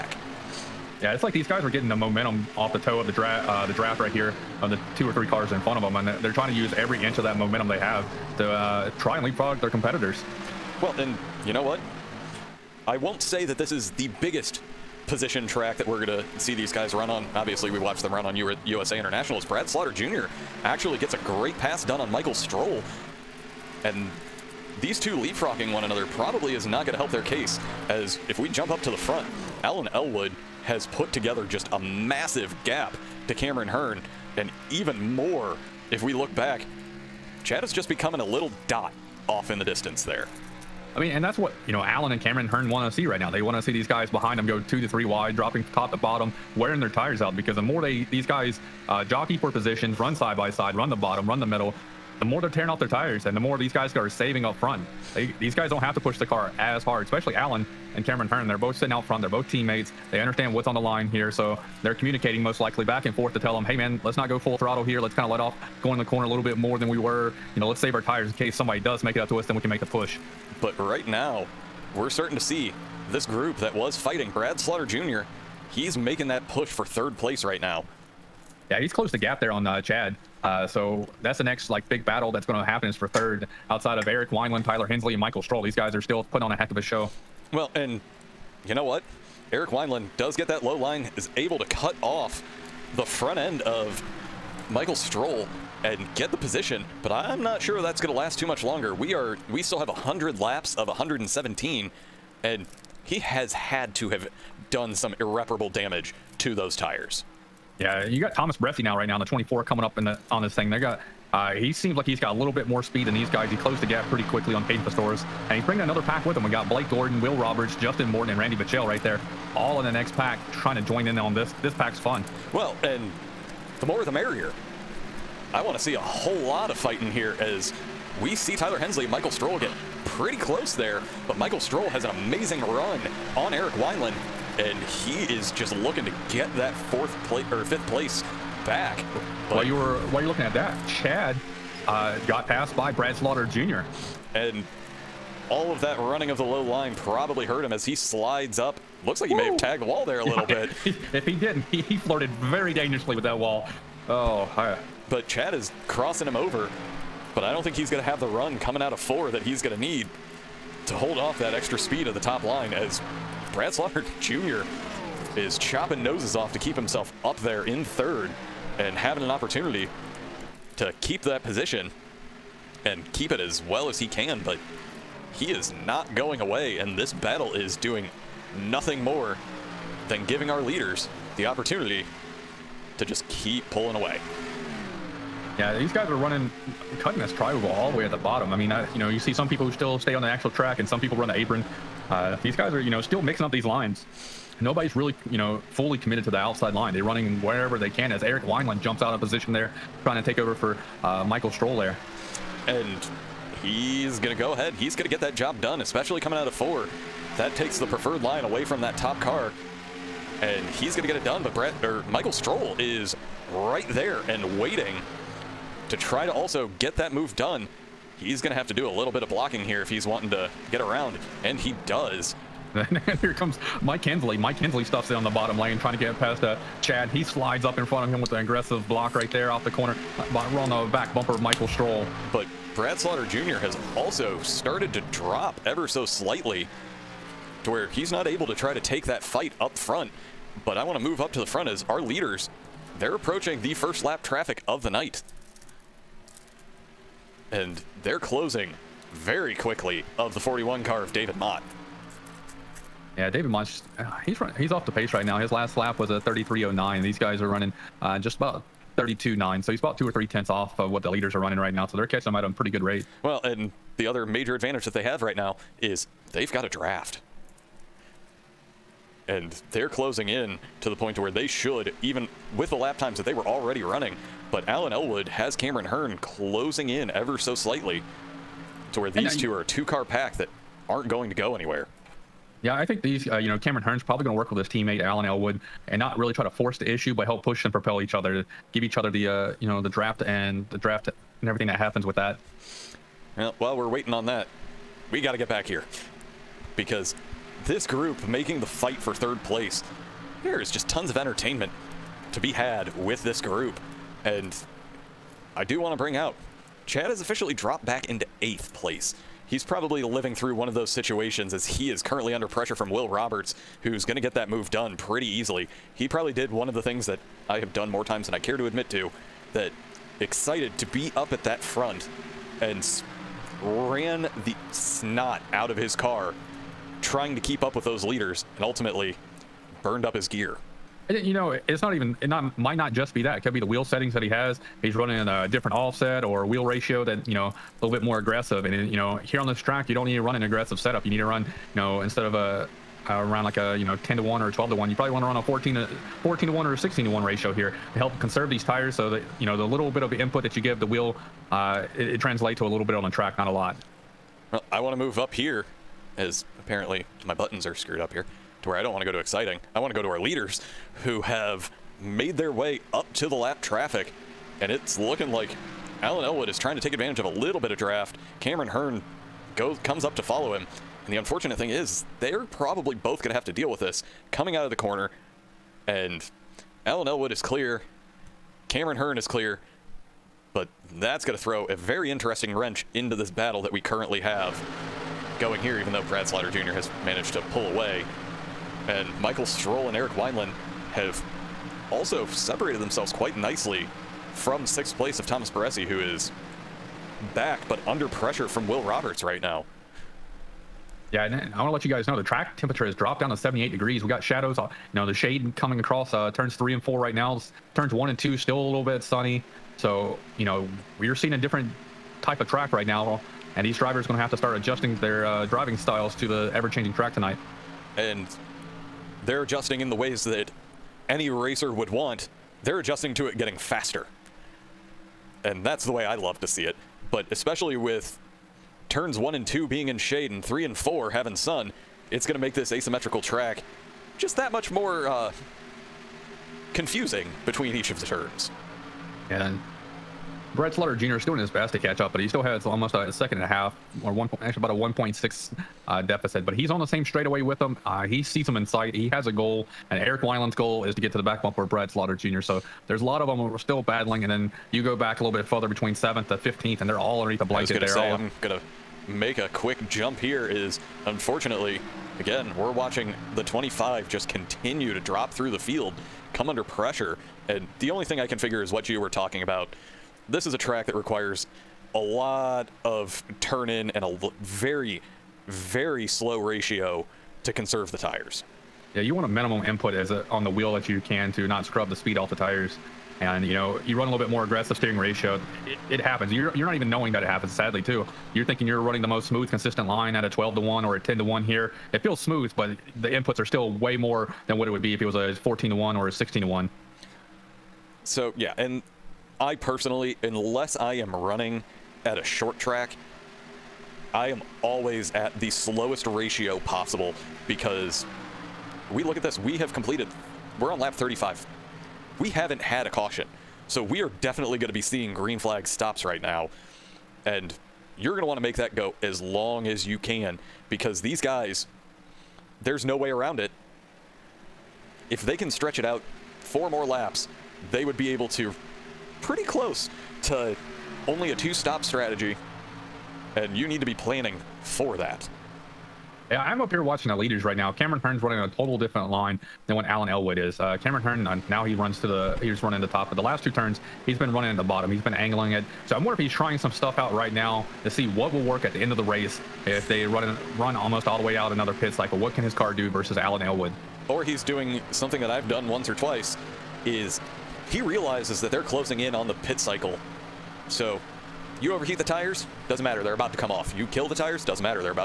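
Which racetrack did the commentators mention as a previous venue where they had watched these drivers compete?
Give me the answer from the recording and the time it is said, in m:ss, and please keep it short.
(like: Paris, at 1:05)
USA International, at 0:18.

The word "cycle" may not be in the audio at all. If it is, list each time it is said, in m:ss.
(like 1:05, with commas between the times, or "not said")
9:11, 9:19.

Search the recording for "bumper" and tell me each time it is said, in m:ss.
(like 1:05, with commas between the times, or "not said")
3:51, 7:31.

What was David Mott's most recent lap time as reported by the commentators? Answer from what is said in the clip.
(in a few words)
33.09.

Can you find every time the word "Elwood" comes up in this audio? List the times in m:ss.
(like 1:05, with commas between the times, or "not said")
0:29, 4:34, 4:45, 6:06, 6:17, 9:00, 9:13.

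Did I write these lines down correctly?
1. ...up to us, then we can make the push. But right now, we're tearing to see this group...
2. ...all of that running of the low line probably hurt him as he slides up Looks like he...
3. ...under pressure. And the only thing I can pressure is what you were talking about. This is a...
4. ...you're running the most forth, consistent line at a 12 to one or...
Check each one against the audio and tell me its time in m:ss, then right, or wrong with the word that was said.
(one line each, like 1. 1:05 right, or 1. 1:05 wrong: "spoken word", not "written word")
1. 1:09 wrong: "starting", not "tearing"
2. 2:25 right
3. 7:46 wrong: "figure", not "pressure"
4. 8:08 wrong: "smooth", not "forth".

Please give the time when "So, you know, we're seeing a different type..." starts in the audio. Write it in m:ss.
6:49.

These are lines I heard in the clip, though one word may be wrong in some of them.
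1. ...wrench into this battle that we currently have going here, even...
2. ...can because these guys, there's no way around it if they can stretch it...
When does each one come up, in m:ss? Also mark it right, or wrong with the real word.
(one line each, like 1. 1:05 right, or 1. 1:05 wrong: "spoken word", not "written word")
1. 6:22 right
2. 8:39 right.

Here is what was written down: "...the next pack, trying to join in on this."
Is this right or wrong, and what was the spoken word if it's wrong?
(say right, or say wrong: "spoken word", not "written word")
right.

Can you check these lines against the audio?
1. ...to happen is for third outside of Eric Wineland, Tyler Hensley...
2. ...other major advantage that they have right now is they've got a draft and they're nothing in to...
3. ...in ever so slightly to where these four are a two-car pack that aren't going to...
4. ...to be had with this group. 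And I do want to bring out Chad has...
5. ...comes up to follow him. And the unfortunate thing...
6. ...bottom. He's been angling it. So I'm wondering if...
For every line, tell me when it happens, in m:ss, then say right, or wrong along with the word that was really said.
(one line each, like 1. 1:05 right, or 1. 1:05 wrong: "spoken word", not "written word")
1. 1:22 right
2. 4:24 wrong: "closing", not "nothing"
3. 4:36 wrong: "two", not "four"
4. 5:02 right
5. 6:09 right
6. 9:04 right.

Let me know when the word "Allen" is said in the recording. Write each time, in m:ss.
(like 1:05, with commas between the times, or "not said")
0:41, 0:57.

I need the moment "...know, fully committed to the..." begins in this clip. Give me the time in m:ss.
3:15.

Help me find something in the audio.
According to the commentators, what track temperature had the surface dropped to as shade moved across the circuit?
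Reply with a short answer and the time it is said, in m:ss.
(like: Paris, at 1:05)
78 degrees, at 6:43.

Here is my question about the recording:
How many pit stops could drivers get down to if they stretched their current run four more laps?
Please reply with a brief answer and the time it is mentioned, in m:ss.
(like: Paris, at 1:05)
2, at 8:51.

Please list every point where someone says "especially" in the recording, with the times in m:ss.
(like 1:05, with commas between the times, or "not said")
0:57, 3:25, 7:07.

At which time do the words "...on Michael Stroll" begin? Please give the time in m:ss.
0:21.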